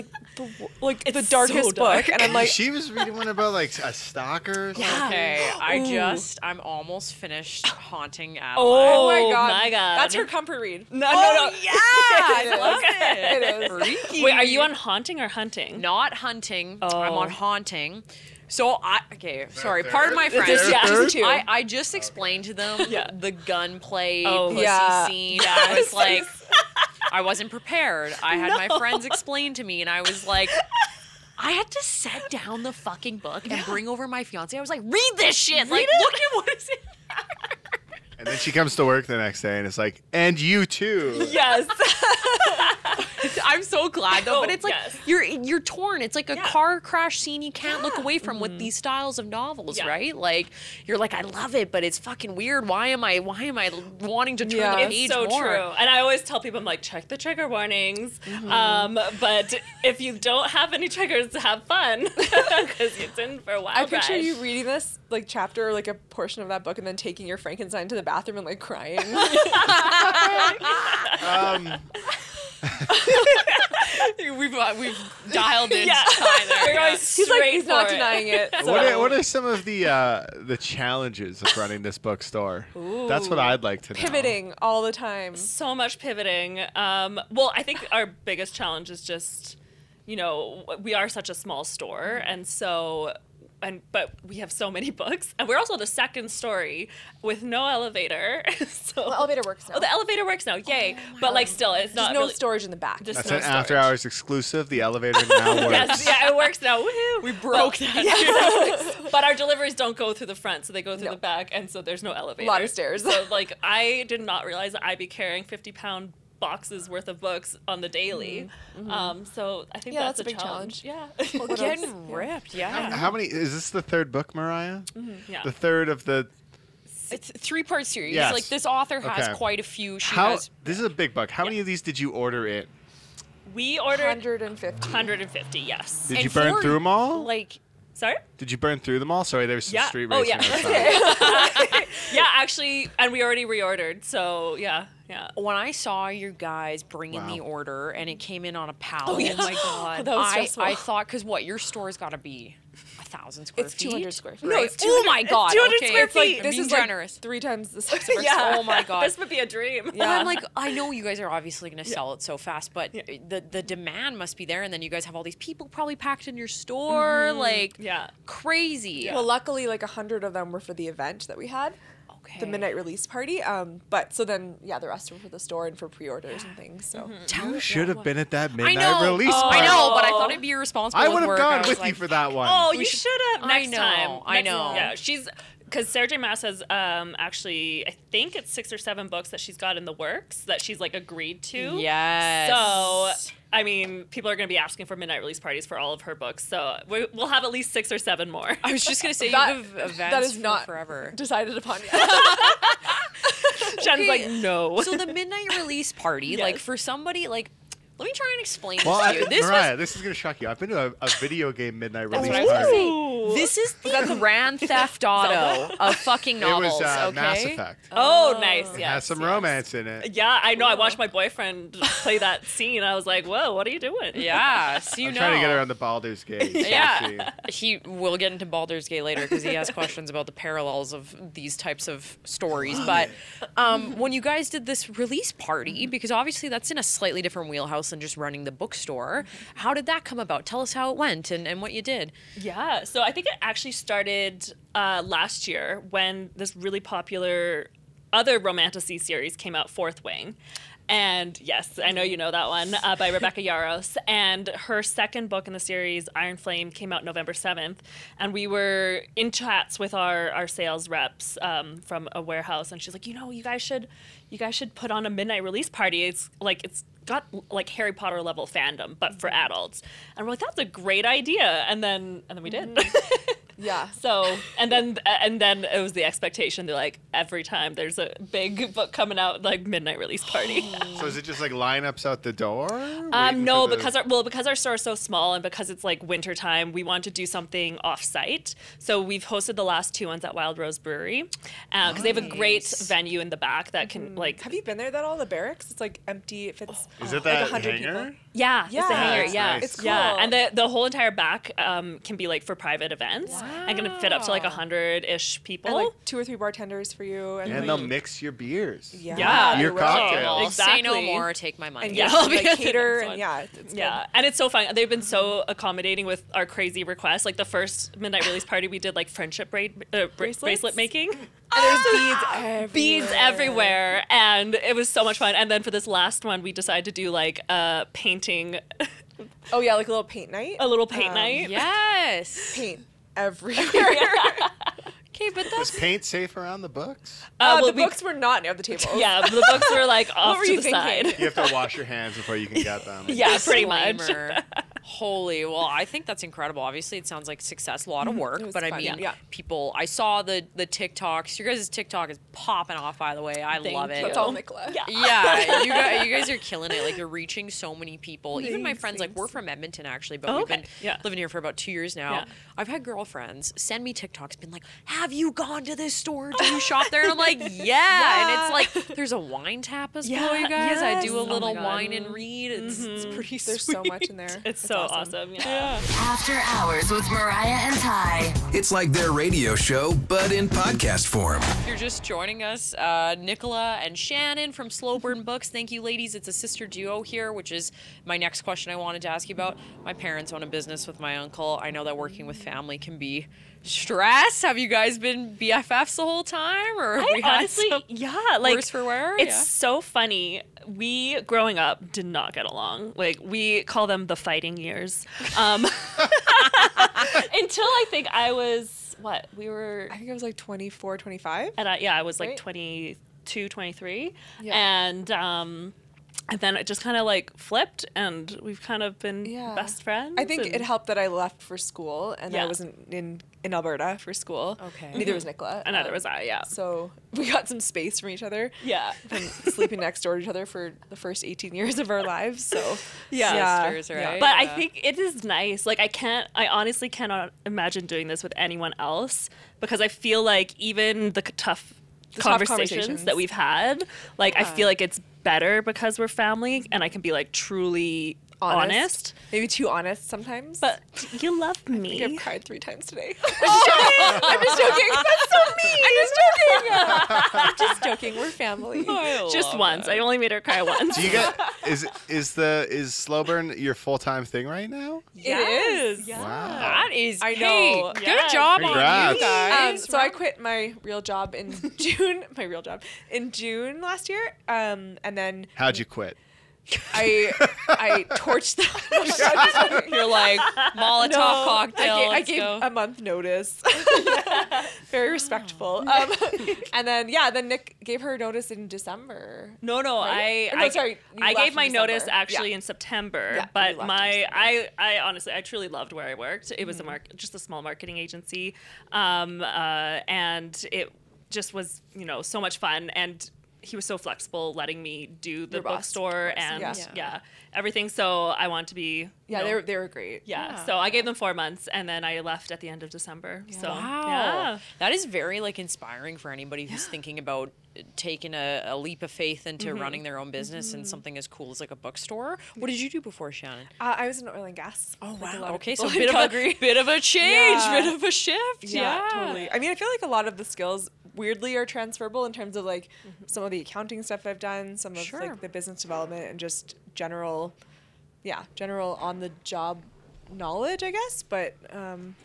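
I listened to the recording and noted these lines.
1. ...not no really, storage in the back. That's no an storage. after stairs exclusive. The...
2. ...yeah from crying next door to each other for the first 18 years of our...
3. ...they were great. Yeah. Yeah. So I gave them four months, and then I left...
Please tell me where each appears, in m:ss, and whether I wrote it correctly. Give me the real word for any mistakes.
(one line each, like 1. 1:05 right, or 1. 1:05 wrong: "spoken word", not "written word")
1. 1:41 wrong: "hours", not "stairs"
2. 7:08 wrong: "sleeping", not "crying"
3. 8:29 right.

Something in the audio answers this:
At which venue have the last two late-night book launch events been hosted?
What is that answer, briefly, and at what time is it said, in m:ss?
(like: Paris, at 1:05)
Wild Rose Brewery, at 4:50.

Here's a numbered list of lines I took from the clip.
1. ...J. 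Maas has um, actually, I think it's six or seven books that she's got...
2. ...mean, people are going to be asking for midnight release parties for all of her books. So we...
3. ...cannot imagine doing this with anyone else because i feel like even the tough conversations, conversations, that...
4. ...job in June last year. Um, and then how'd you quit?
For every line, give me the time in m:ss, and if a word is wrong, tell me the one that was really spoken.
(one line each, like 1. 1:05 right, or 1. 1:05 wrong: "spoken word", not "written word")
1. 3:06 right
2. 3:13 right
3. 7:16 right
4. 7:52 right.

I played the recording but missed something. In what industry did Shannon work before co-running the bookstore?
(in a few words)
oil and gas.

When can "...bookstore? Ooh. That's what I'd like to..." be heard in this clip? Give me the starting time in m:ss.
1:21.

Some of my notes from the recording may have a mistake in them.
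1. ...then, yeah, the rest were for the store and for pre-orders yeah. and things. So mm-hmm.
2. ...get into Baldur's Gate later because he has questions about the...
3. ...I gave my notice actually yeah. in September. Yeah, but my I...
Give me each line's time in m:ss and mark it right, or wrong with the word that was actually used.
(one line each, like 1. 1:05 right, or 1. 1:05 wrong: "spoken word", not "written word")
1. 2:54 right
2. 3:48 right
3. 8:11 right.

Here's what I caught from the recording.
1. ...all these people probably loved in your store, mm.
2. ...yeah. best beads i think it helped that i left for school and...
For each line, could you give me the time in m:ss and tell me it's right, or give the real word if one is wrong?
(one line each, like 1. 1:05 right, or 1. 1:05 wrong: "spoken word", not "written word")
1. 2:45 wrong: "packed", not "loved"
2. 6:59 wrong: "friends", not "beads".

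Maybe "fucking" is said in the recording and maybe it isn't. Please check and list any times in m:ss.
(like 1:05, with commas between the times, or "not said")
0:32, 0:52, 3:35.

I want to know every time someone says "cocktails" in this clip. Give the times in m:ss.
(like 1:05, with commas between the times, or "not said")
5:09, 8:01.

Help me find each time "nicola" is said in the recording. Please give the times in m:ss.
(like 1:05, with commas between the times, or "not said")
5:54, 6:23, 7:05.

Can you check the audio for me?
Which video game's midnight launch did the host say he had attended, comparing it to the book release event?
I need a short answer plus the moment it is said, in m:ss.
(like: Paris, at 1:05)
Mass Effect, at 3:37.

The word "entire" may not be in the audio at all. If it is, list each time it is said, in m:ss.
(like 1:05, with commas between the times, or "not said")
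5:00.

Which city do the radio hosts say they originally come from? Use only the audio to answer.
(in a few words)
Edmonton.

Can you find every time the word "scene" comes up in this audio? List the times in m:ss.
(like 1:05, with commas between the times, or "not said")
0:25, 0:47, 3:42.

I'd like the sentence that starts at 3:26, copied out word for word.
like for somebody like let me try and explain well, this to you.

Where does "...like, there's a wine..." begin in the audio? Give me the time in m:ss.
6:08.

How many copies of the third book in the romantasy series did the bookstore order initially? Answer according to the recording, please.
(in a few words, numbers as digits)
150.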